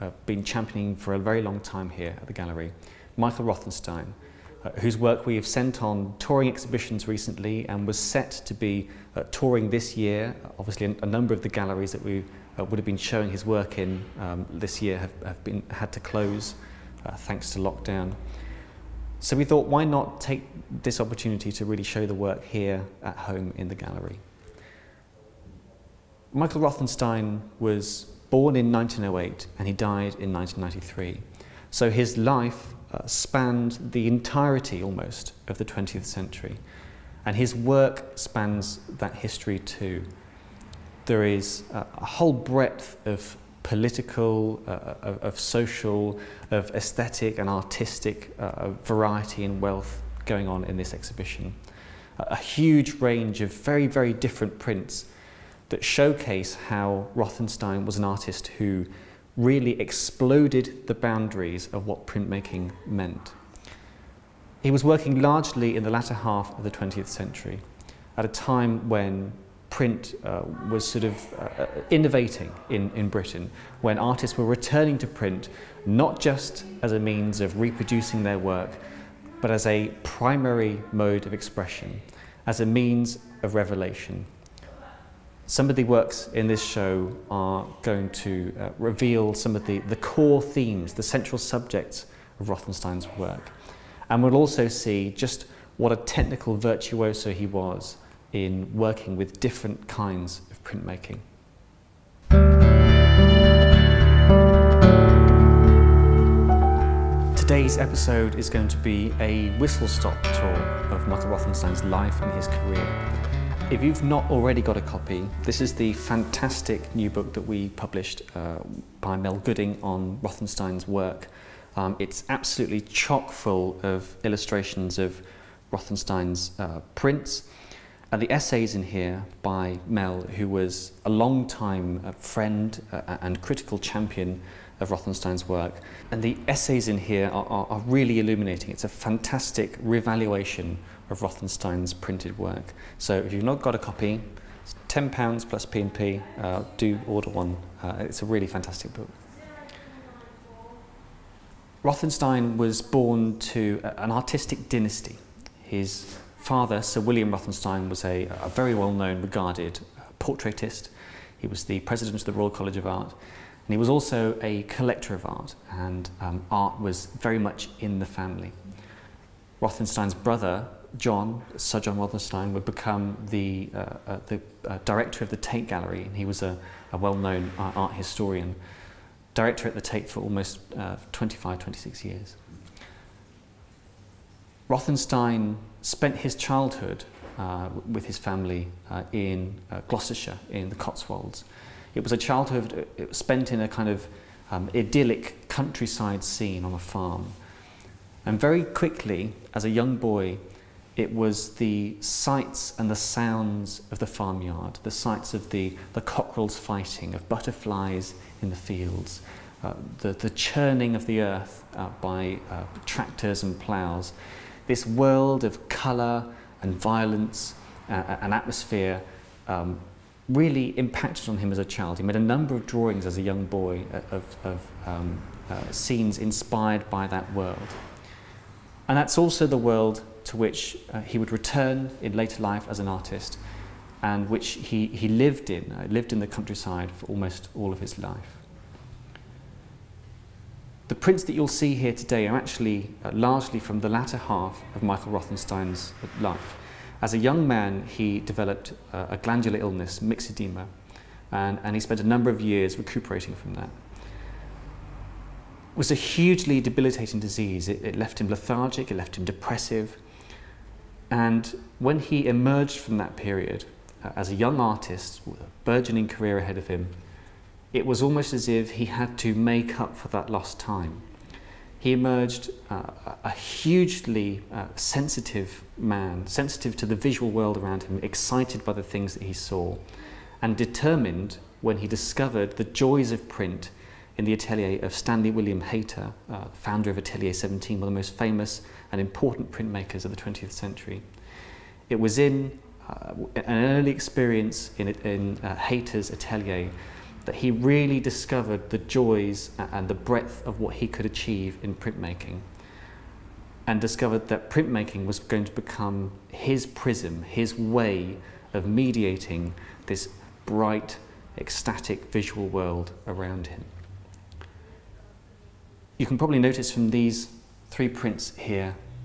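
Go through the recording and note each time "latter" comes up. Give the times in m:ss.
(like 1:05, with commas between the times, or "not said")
1:05, 4:03.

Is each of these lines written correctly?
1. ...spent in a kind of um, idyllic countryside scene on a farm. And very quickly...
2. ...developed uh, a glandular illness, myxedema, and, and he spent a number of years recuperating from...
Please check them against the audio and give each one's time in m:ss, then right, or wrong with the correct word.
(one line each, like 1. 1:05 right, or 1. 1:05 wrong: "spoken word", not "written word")
1. 3:13 right
2. 4:08 right.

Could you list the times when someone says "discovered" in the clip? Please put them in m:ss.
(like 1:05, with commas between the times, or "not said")
4:41, 4:57, 5:03.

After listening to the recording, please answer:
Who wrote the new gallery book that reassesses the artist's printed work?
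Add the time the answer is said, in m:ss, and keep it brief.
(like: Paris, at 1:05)
Mel Gooding, at 1:59.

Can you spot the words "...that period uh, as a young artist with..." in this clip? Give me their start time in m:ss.
4:22.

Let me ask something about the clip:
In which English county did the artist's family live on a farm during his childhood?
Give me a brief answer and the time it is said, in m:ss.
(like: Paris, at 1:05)
Gloucestershire, at 3:09.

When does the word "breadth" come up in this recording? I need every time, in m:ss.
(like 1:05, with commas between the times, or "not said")
0:42, 4:59.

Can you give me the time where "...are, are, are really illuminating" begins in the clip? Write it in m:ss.
2:17.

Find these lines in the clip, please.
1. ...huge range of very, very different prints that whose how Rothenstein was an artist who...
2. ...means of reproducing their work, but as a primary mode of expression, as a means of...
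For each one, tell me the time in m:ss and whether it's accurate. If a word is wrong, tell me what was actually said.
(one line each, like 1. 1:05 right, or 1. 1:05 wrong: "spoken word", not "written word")
1. 0:52 wrong: "showcase", not "whose"
2. 1:16 right.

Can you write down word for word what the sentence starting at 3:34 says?
This world of colour and violence uh, and atmosphere um, really impacted on him as a child.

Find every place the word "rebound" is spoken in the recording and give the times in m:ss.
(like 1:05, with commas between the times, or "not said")
not said.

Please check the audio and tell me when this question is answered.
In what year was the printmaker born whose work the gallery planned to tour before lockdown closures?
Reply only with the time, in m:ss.
0:28.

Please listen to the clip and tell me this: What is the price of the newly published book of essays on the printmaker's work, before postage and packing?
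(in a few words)
£10.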